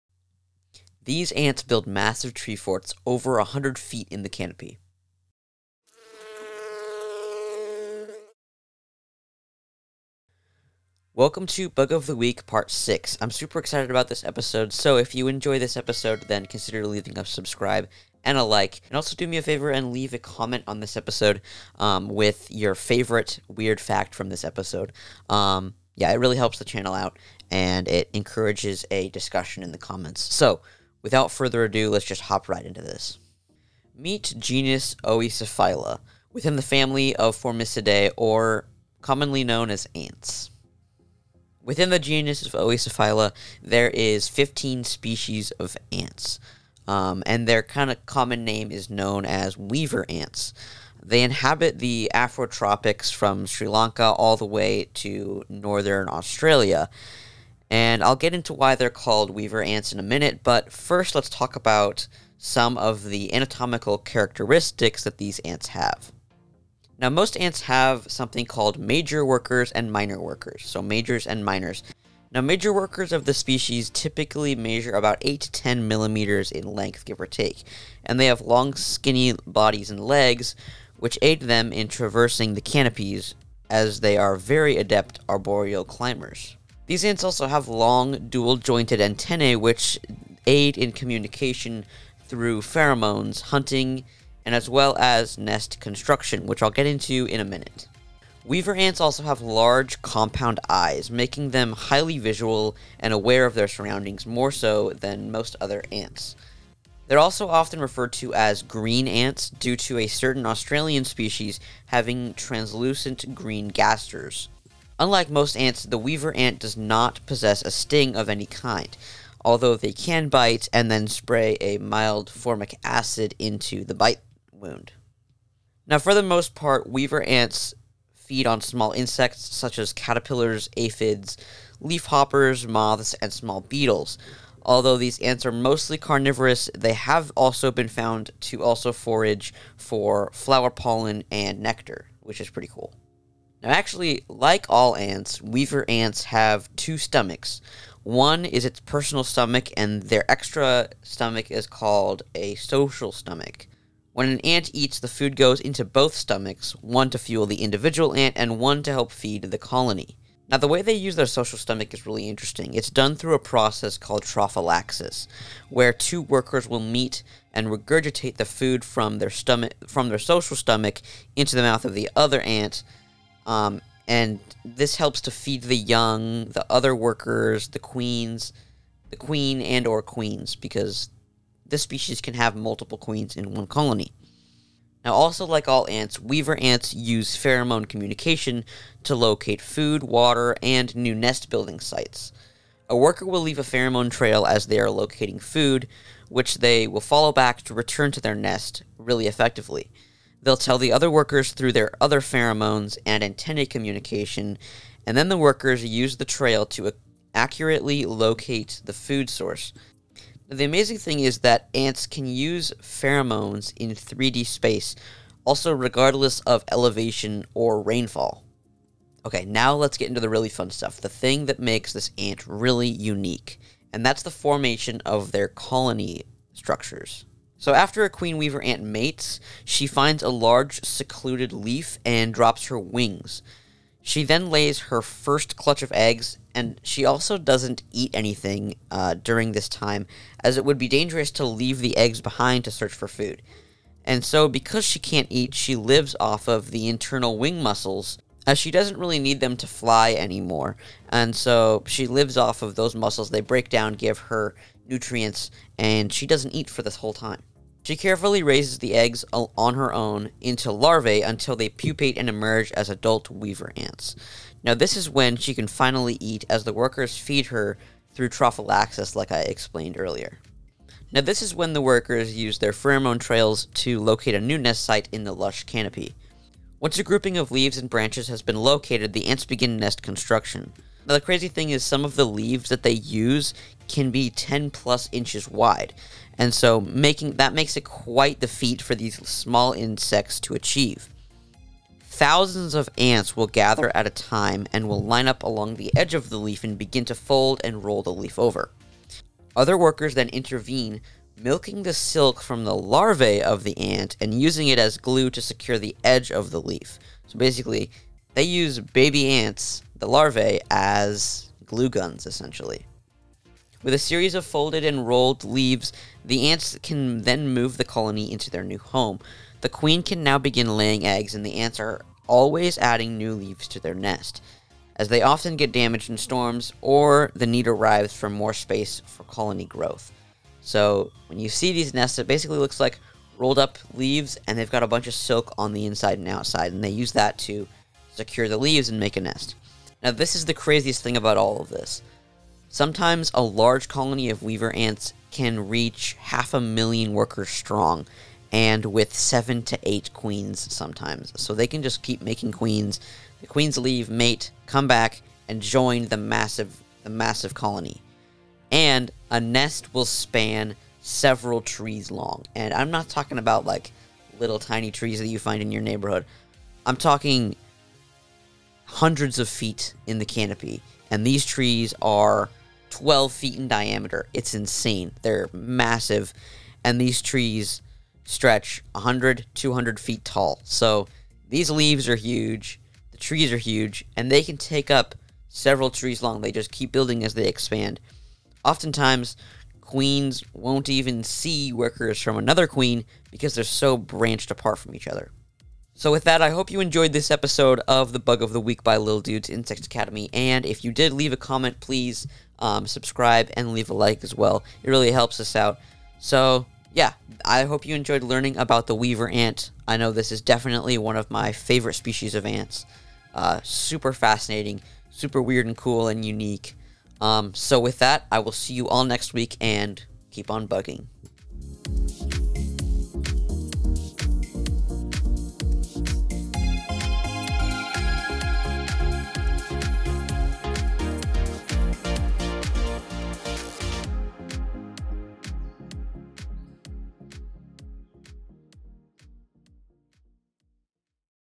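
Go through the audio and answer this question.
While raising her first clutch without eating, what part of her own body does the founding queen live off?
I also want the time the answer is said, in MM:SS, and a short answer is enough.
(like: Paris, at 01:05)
internal wing muscles, at 04:06.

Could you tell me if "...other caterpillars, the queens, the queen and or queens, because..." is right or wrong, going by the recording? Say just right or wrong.
wrong.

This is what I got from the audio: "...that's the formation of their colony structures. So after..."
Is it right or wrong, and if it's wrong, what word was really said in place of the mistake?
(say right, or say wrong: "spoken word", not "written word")
right.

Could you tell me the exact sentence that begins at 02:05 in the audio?
Now, for the most part, weaver ants feed on small insects such as caterpillars, aphids, leafhoppers, moths, and small beetles.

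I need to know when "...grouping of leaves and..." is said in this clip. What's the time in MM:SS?
04:37.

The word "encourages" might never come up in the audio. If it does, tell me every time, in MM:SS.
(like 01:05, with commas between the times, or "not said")
00:28.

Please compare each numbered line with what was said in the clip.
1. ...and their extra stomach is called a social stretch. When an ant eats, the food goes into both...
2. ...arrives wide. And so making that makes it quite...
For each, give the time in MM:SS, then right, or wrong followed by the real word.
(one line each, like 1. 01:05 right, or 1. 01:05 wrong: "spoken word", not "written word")
1. 02:29 wrong: "stomach", not "stretch"
2. 04:45 wrong: "inches", not "arrives".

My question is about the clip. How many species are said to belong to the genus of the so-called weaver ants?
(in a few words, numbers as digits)
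15.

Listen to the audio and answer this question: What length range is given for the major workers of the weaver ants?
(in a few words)
8 to 10 millimeters.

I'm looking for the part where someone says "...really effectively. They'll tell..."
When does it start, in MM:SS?
03:18.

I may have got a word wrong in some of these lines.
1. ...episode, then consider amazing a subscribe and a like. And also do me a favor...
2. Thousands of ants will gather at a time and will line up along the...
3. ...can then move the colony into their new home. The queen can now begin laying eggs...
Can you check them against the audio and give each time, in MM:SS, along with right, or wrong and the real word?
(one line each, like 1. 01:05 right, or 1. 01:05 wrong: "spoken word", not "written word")
1. 00:15 wrong: "leaving", not "amazing"
2. 04:52 right
3. 05:16 right.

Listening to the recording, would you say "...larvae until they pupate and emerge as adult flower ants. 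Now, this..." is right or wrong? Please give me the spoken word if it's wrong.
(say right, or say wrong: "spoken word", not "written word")
wrong: "weaver", not "flower".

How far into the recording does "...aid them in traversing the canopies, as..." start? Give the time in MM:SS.
01:21.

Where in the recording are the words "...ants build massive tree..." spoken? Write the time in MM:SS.
00:01.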